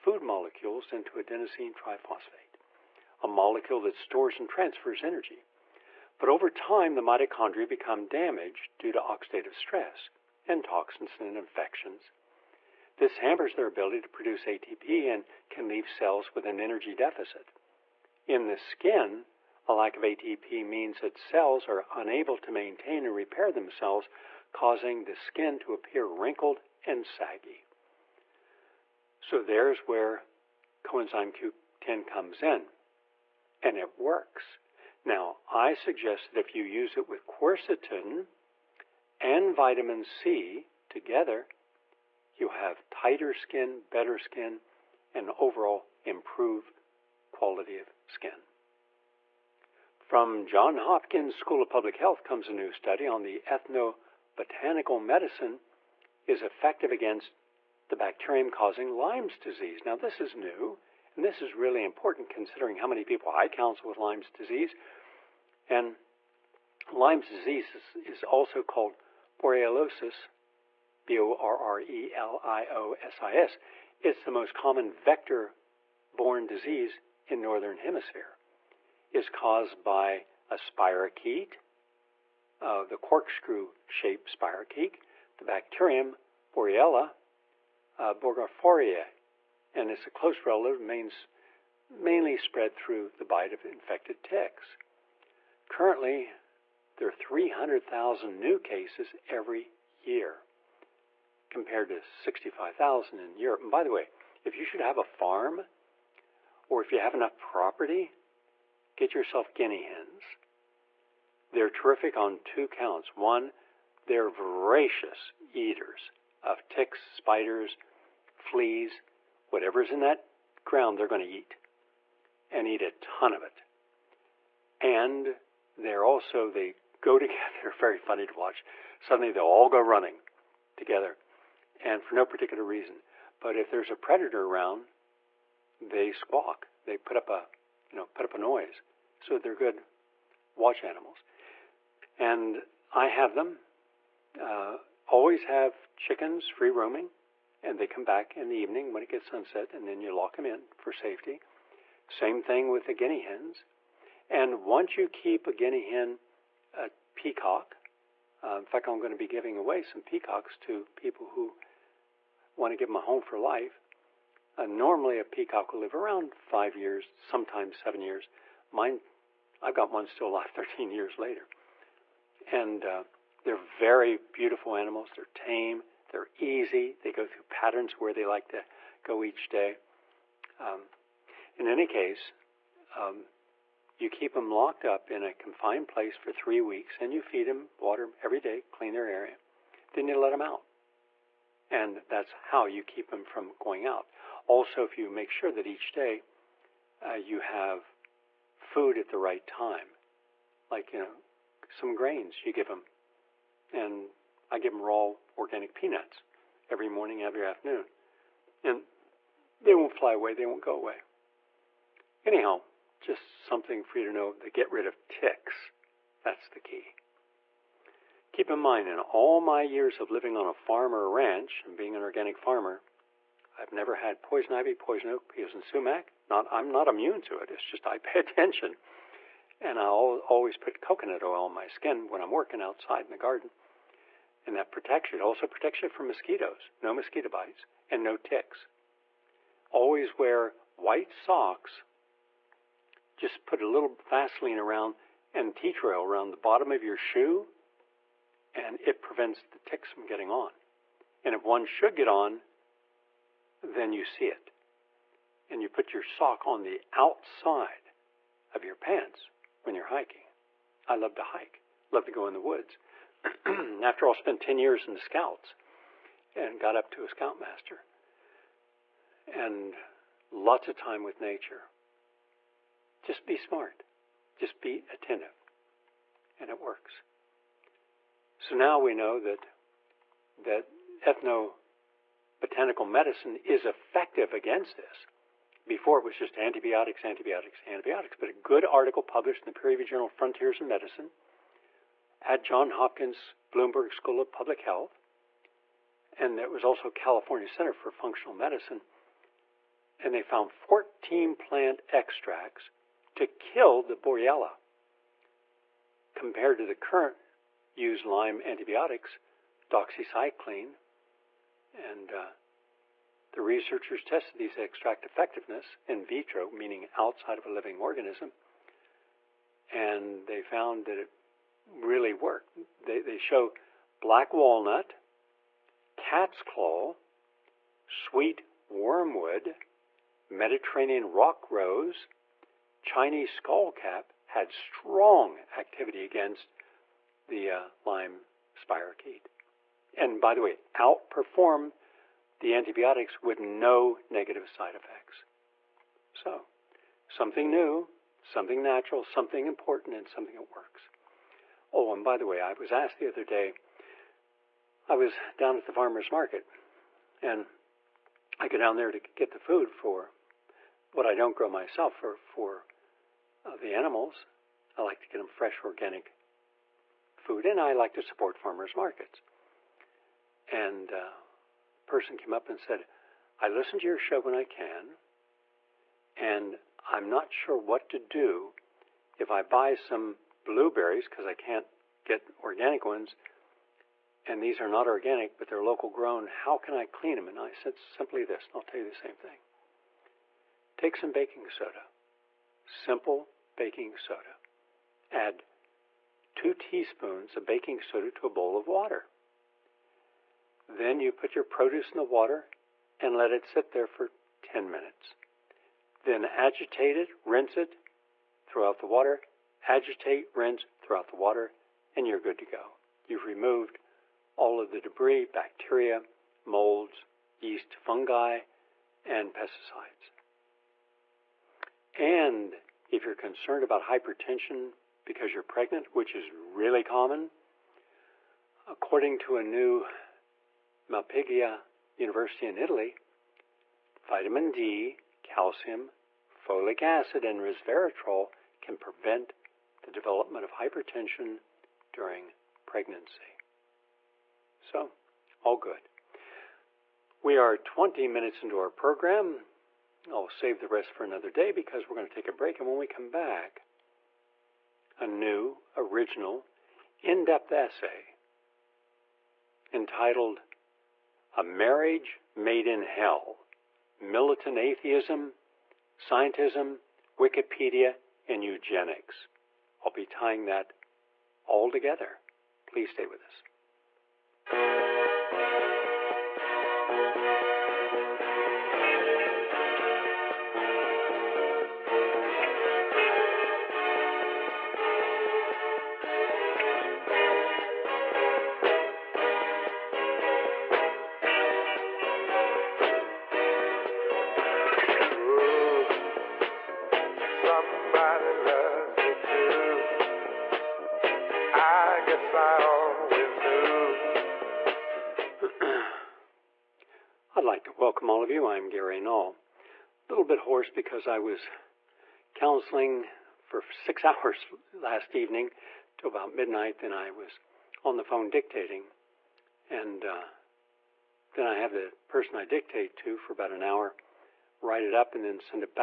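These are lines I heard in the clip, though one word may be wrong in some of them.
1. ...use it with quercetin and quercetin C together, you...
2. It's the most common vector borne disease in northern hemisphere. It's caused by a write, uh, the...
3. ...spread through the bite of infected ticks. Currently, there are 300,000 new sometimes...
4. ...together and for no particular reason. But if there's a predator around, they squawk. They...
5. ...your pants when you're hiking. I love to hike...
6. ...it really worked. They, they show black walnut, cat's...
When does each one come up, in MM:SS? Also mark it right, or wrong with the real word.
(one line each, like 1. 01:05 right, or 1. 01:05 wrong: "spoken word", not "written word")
1. 00:36 wrong: "vitamin", not "quercetin"
2. 01:14 wrong: "spirochete", not "write"
3. 01:32 wrong: "cases", not "sometimes"
4. 02:10 right
5. 04:18 right
6. 05:20 right.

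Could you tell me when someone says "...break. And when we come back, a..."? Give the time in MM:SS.
07:32.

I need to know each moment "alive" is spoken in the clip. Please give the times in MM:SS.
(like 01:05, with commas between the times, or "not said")
02:50.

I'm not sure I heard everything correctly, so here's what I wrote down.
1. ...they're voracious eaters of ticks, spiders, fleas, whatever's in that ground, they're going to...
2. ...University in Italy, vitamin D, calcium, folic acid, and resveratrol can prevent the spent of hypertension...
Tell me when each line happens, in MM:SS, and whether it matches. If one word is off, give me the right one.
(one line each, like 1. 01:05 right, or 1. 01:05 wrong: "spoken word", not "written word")
1. 01:54 right
2. 07:11 wrong: "development", not "spent".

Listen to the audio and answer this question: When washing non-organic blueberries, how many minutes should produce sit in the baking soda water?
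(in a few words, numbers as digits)
10.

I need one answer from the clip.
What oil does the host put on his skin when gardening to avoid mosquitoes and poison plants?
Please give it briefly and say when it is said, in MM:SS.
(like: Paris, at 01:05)
Coconut oil, at 03:50.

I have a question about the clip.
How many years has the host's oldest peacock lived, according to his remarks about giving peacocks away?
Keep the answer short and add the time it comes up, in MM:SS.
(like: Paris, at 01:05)
13, at 02:50.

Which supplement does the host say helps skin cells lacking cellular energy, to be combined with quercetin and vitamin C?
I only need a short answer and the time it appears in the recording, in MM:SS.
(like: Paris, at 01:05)
Coenzyme Q10, at 00:30.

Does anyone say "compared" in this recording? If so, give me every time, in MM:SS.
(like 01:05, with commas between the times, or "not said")
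01:41, 05:06.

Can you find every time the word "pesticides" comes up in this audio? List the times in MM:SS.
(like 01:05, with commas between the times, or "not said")
06:59.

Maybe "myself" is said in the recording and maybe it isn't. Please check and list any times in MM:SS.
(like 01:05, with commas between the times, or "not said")
06:01.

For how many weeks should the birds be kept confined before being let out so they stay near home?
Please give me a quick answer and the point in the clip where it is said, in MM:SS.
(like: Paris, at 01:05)
3, at 03:06.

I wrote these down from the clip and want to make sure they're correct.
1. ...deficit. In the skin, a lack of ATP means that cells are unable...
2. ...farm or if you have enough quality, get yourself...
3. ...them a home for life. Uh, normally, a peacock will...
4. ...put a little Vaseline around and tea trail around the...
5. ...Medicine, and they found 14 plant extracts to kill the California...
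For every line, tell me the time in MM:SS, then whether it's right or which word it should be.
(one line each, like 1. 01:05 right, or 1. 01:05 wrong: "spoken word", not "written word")
1. 00:16 right
2. 01:45 wrong: "property", not "quality"
3. 02:42 right
4. 04:03 right
5. 04:58 wrong: "Borrelia", not "California".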